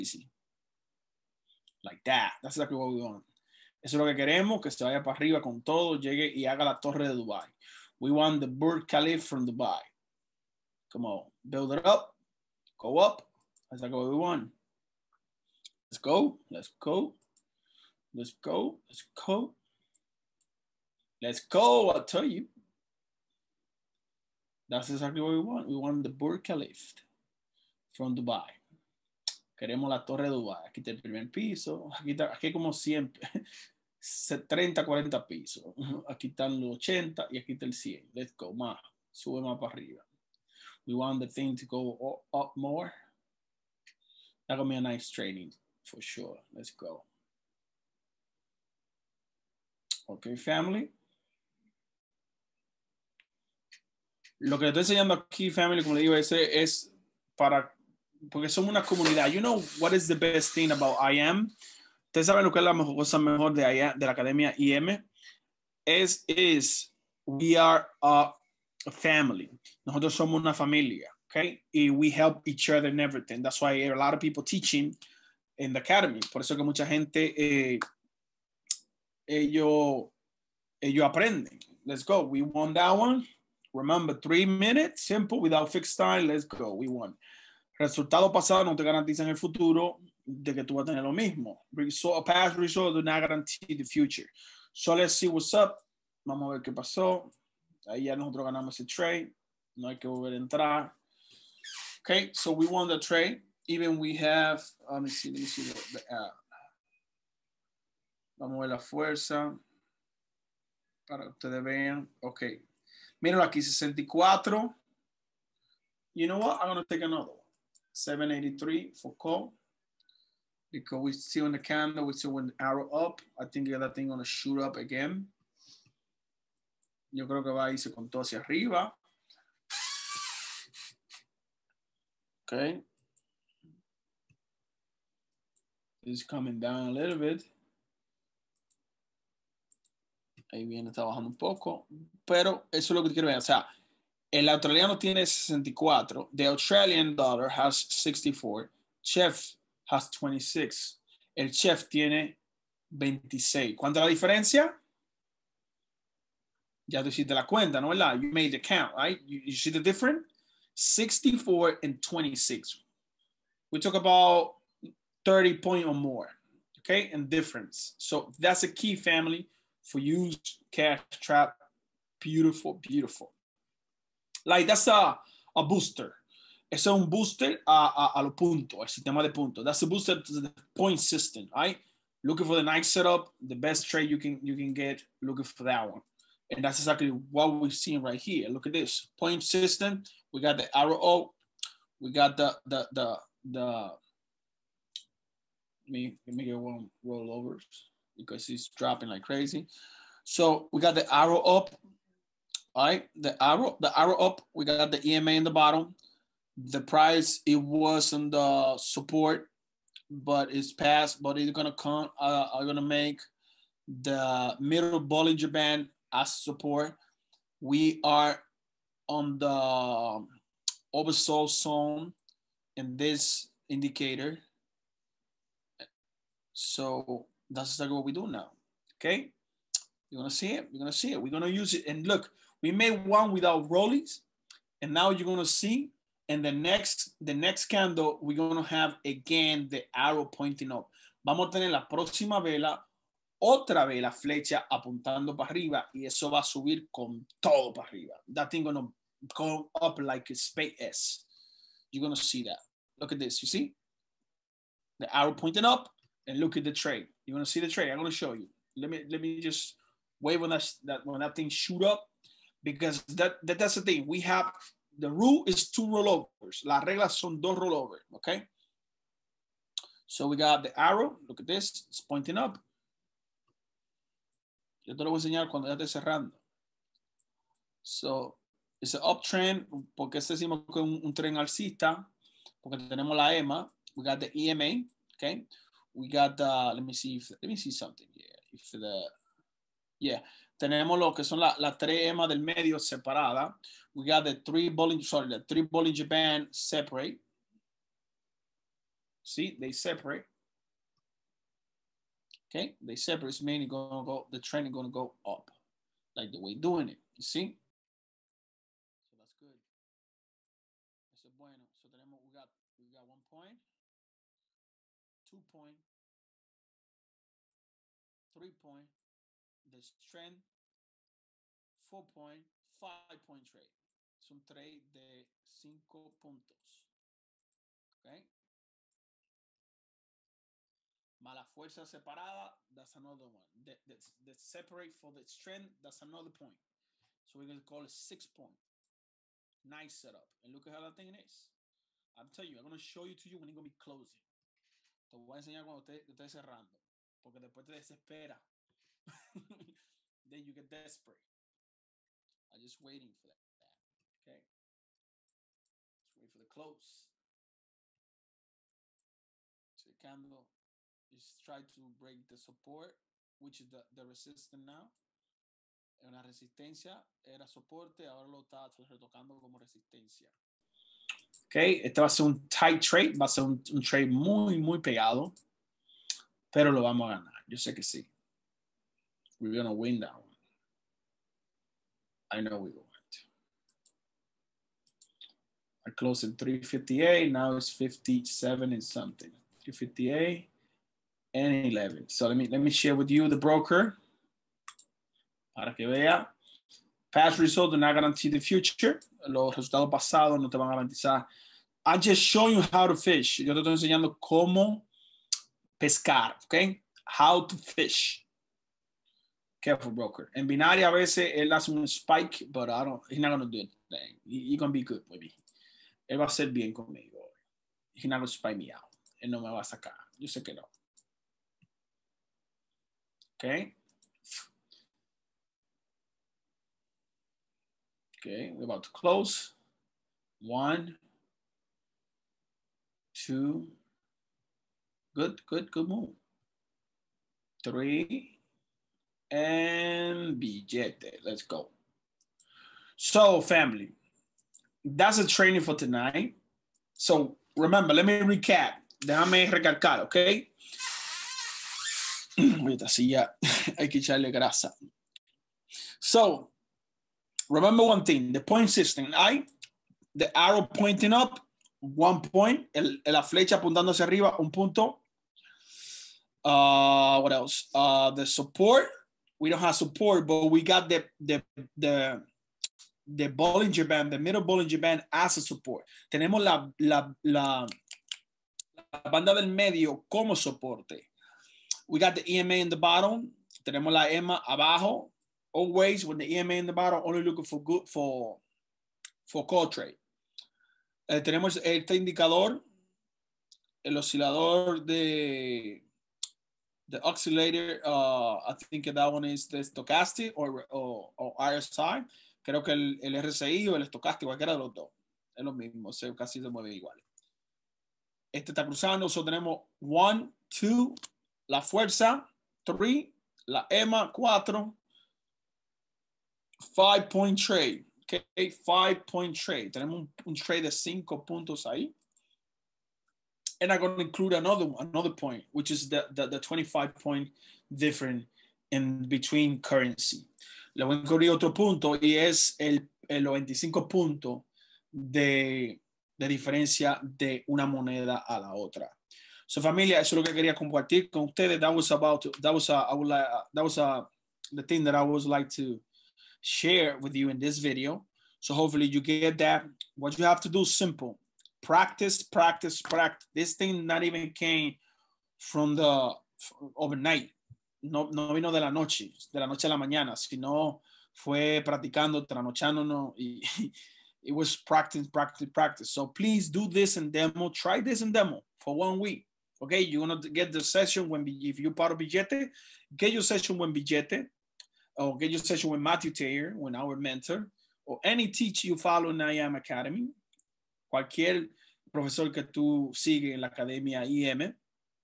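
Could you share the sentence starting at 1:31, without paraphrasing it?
Result, past result do not guarantee the future.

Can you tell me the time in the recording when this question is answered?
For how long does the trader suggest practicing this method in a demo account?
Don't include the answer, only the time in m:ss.
9:28.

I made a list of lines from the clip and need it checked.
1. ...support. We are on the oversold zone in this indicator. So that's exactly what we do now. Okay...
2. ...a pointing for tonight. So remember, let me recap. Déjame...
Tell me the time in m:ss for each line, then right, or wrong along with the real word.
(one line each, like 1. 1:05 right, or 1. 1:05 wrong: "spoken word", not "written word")
1. 3:36 right
2. 7:25 wrong: "training", not "pointing".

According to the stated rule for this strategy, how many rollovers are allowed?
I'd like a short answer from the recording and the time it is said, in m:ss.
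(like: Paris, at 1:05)
2, at 4:25.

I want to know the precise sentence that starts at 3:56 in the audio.
And the next, the next candle, we're gonna have again the arrow pointing up.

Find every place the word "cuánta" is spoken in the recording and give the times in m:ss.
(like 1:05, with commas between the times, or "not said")
2:33.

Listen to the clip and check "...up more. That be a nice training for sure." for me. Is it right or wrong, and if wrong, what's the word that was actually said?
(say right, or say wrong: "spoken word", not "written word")
right.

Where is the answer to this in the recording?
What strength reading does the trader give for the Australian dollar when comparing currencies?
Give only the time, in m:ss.
2:26.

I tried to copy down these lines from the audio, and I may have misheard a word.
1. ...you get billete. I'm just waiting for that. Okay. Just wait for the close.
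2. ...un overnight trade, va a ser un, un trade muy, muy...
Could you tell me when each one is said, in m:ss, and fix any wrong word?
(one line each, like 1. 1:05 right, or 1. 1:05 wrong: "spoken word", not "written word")
1. 5:50 wrong: "desperate", not "billete"
2. 6:12 wrong: "tight", not "overnight".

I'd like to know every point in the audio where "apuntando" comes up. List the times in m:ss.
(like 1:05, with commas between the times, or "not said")
4:04, 7:43.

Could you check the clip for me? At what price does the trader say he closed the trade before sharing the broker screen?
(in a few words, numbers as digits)
358.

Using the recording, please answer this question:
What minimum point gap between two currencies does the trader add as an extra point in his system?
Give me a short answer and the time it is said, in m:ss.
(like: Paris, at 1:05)
25, at 8:46.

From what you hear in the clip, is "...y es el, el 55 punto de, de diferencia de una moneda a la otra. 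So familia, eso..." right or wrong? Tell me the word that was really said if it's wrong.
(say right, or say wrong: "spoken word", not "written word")
wrong: "25", not "55".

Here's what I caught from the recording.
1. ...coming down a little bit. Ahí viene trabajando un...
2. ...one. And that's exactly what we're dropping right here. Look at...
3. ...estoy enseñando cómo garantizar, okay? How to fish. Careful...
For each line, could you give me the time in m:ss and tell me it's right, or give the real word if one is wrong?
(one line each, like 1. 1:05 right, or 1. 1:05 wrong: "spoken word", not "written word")
1. 2:16 right
2. 3:05 wrong: "seeing", not "dropping"
3. 6:43 wrong: "pescar", not "garantizar".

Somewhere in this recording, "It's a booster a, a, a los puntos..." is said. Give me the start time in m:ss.
2:56.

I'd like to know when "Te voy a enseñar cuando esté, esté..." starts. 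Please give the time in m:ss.
5:45.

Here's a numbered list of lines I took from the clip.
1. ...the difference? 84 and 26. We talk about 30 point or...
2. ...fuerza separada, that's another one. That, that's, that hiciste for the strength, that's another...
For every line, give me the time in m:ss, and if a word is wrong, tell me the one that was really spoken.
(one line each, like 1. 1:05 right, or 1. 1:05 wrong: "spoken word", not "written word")
1. 2:39 wrong: "64", not "84"
2. 5:31 wrong: "separate", not "hiciste".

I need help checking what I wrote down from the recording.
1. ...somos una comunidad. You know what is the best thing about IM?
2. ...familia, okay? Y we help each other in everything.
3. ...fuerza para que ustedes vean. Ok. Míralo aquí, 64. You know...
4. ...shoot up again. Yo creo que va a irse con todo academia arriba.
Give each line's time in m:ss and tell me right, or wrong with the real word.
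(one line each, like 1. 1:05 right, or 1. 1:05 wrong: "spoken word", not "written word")
1. 0:58 right
2. 1:10 right
3. 1:48 right
4. 2:04 wrong: "hacia", not "academia".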